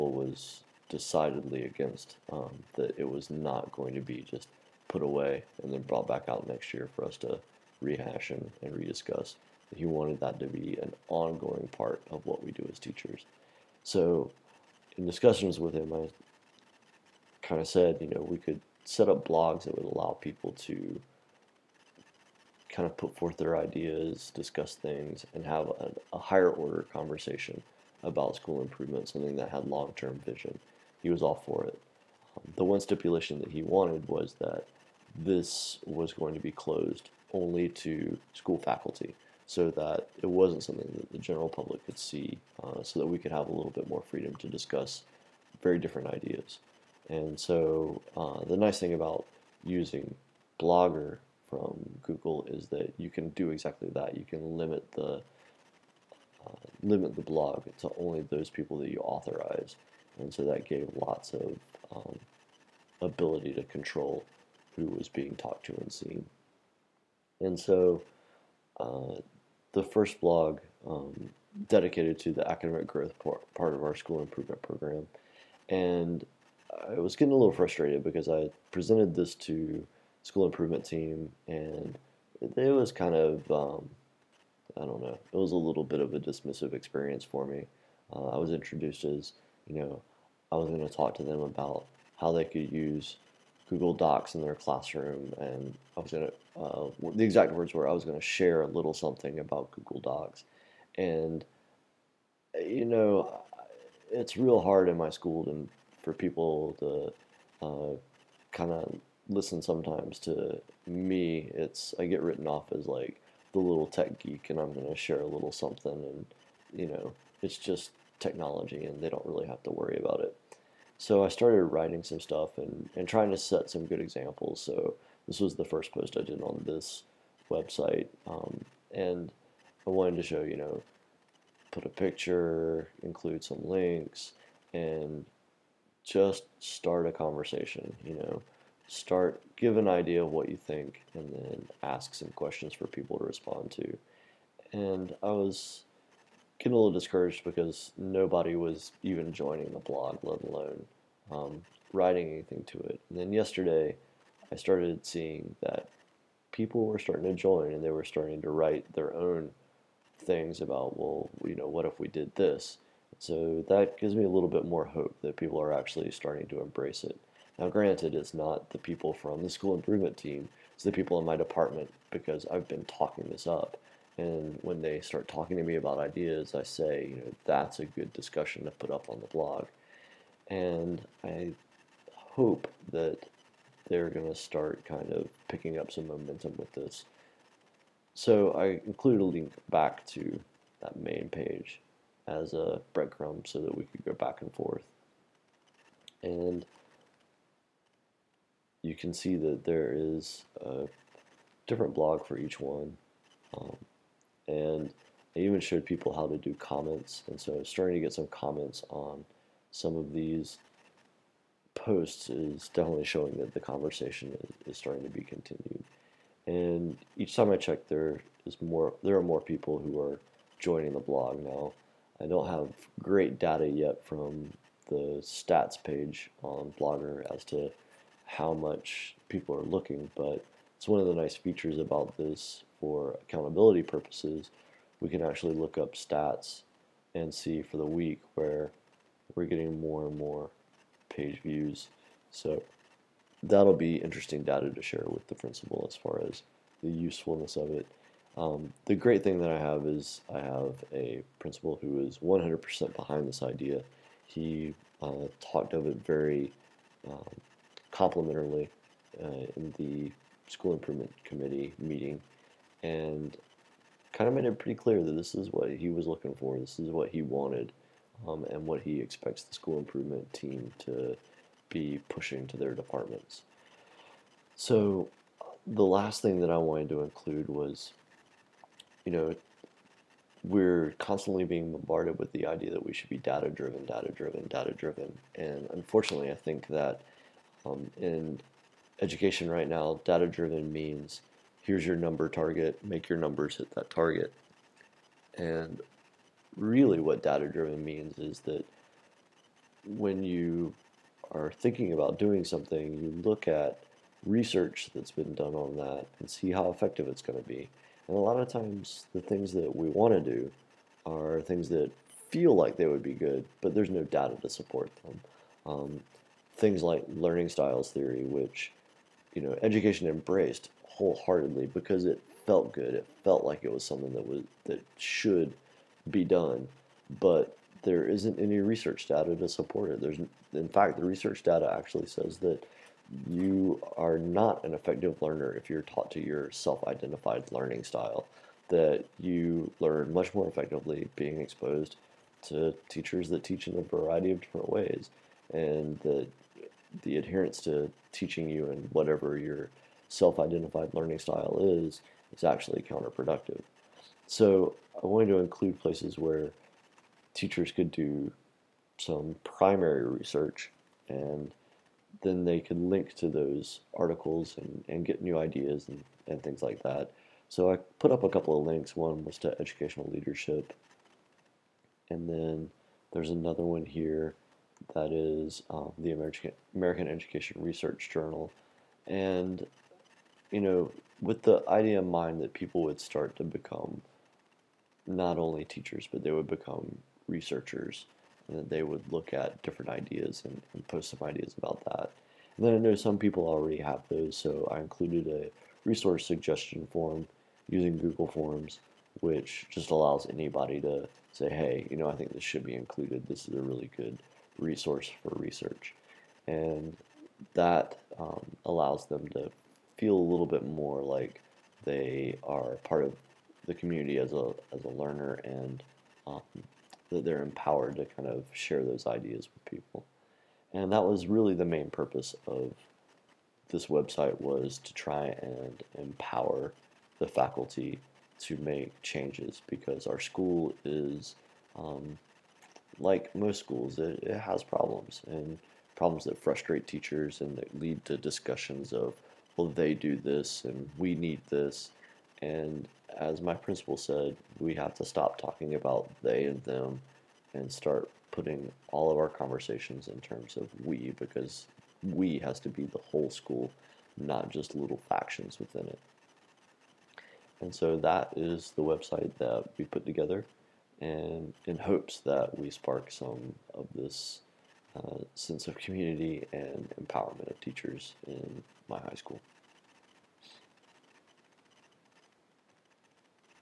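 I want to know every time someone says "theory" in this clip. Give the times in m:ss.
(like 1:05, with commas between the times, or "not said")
5:17.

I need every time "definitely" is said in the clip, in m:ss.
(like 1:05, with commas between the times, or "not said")
3:32.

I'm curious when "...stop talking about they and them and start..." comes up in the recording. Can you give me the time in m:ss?
7:25.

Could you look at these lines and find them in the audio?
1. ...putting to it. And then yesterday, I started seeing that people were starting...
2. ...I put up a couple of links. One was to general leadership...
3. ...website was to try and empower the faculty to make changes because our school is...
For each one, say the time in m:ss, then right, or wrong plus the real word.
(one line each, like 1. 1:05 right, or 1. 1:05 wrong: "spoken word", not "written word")
1. 2:32 wrong: "anything", not "putting"
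2. 6:07 wrong: "educational", not "general"
3. 7:03 right.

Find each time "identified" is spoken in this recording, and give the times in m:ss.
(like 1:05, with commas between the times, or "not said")
5:36, 5:50.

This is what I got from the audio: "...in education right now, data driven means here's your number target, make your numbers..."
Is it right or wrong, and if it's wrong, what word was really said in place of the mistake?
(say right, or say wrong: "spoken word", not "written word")
right.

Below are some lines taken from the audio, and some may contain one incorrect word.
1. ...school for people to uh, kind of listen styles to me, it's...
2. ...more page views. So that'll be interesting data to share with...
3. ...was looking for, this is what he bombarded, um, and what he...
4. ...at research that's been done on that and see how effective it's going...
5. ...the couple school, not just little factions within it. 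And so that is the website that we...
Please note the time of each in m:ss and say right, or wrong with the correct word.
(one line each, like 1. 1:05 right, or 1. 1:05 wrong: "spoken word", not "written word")
1. 1:45 wrong: "sometimes", not "styles"
2. 4:00 right
3. 4:25 wrong: "wanted", not "bombarded"
4. 5:03 right
5. 7:32 wrong: "whole", not "couple".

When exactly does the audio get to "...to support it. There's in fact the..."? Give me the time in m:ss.
5:29.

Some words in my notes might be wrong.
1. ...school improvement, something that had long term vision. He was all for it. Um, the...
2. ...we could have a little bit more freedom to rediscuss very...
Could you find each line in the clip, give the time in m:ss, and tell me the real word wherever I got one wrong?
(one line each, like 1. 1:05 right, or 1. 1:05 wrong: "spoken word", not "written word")
1. 0:28 right
2. 0:43 wrong: "discuss", not "rediscuss".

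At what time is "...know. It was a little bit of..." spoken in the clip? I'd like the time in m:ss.
1:24.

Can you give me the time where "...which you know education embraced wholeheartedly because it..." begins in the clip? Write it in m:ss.
5:18.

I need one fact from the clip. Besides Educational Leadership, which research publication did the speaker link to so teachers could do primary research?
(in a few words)
American Education Research Journal.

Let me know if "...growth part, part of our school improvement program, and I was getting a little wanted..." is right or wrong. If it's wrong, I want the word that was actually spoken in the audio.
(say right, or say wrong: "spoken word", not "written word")
wrong: "frustrated", not "wanted".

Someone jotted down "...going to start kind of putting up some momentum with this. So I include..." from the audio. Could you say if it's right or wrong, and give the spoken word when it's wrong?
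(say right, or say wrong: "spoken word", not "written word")
wrong: "picking", not "putting".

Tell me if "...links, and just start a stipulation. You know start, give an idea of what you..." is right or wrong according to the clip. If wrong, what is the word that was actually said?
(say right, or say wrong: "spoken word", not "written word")
wrong: "conversation", not "stipulation".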